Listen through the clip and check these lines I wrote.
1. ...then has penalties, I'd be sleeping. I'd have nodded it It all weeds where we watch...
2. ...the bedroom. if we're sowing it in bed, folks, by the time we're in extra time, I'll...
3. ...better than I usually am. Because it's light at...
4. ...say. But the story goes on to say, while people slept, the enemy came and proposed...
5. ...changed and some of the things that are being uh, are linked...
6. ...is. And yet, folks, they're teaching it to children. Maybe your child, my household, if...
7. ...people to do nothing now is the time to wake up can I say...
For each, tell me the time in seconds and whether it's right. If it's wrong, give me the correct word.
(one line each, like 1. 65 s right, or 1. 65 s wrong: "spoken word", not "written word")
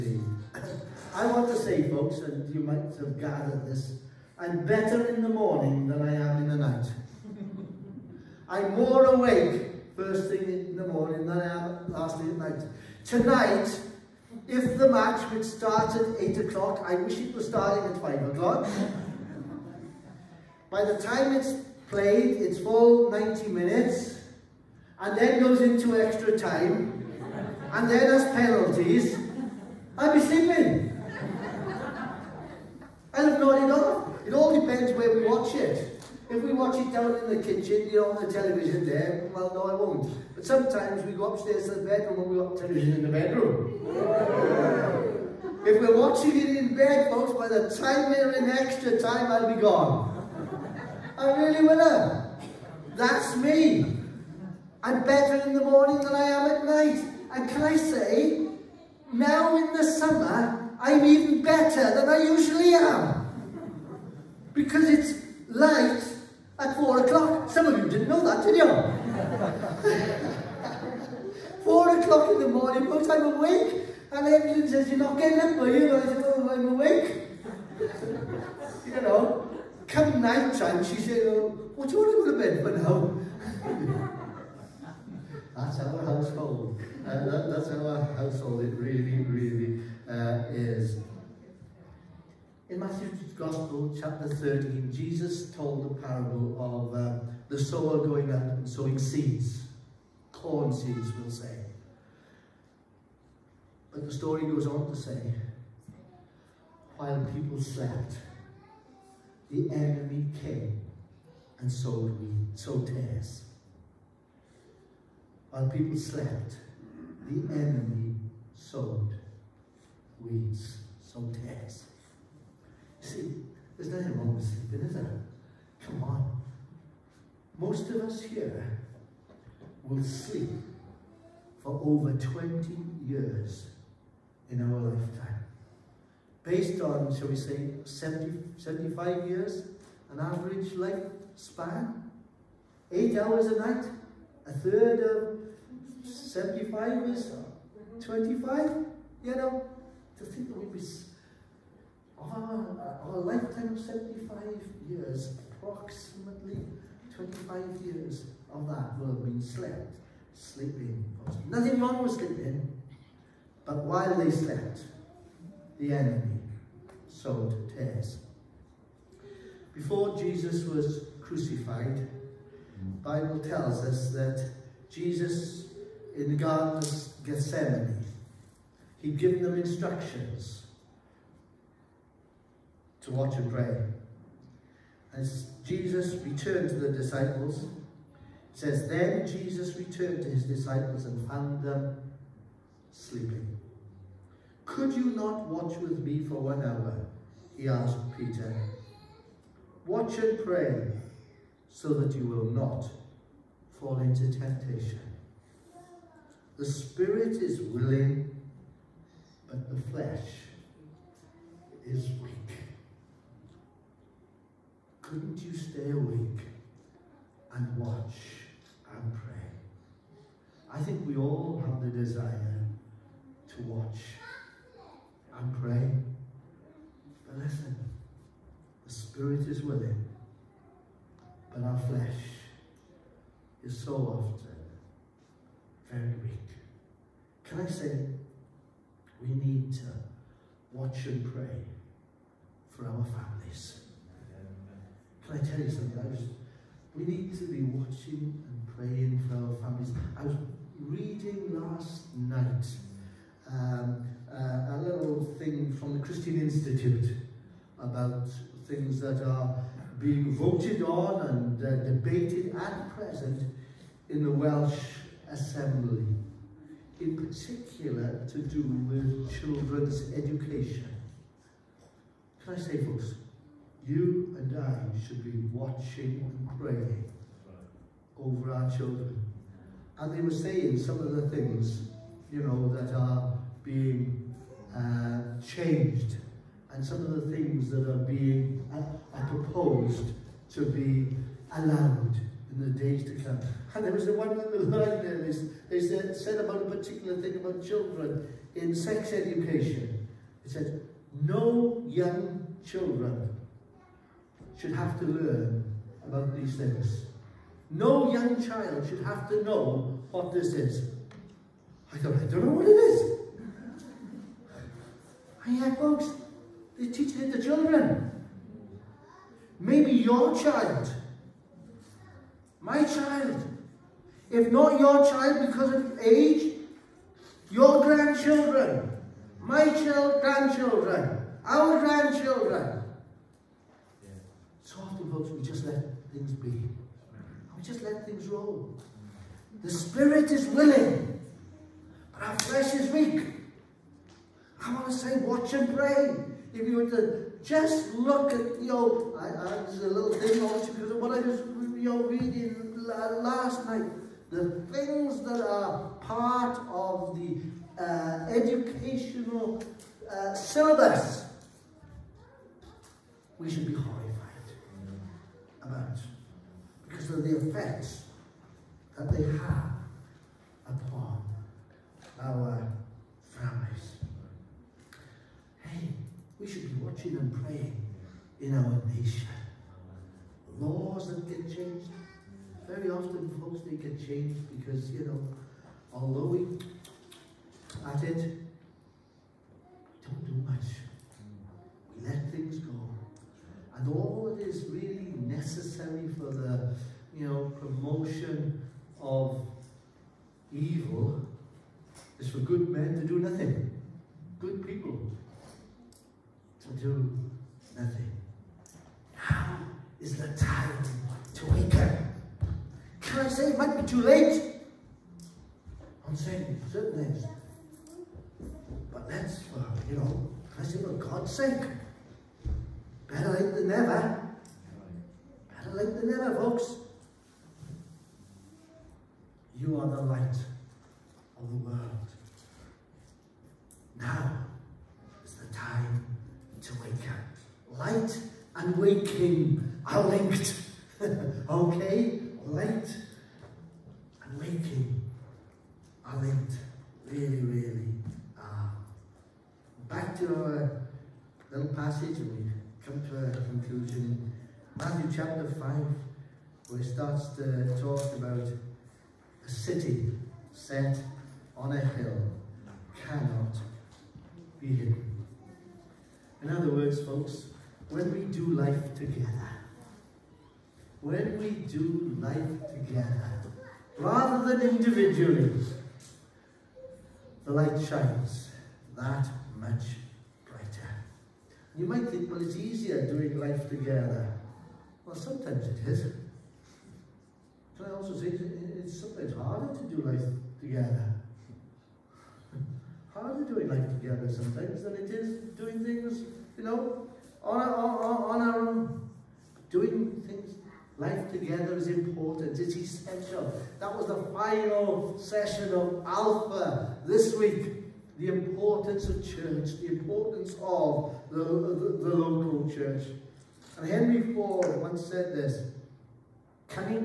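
1. 27 s wrong: "depends", not "weeds"
2. 43 s wrong: "watching", not "sowing"
3. 61 s right
4. 101 s wrong: "sowed", not "proposed"
5. 285 s wrong: "proposed", not "linked"
6. 312 s wrong: "child", not "household"
7. 404 s right.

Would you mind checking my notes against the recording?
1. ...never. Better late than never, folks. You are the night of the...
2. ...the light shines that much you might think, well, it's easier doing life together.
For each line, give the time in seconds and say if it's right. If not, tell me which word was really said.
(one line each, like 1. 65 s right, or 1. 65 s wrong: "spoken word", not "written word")
1. 423 s wrong: "light", not "night"
2. 477 s right.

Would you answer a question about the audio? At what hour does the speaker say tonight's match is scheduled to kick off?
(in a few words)
8 o'clock.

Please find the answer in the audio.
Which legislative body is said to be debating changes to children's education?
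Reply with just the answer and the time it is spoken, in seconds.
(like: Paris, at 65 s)
Welsh Assembly, at 264 s.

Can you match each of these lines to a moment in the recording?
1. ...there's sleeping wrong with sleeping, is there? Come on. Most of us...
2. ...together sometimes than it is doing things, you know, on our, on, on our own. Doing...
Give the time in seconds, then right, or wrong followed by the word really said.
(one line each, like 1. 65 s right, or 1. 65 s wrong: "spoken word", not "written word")
1. 123 s wrong: "nothing", not "sleeping"
2. 493 s right.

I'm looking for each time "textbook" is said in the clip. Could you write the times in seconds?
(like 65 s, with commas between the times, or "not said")
not said.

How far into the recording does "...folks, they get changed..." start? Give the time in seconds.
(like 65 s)
383 s.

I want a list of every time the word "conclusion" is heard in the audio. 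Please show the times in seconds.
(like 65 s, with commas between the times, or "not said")
453 s.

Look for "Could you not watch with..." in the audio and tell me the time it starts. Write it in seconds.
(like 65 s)
194 s.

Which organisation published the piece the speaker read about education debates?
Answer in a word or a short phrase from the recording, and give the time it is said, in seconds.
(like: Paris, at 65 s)
Christian Institute, at 256 s.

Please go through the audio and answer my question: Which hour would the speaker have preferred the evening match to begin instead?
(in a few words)
5 o'clock.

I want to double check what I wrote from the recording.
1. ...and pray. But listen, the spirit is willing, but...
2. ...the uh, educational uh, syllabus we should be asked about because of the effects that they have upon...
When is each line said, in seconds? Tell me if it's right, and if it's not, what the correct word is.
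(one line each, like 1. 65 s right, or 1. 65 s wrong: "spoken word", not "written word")
1. 225 s right
2. 357 s wrong: "horrified", not "asked".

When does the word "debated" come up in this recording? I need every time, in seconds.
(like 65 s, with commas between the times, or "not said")
261 s.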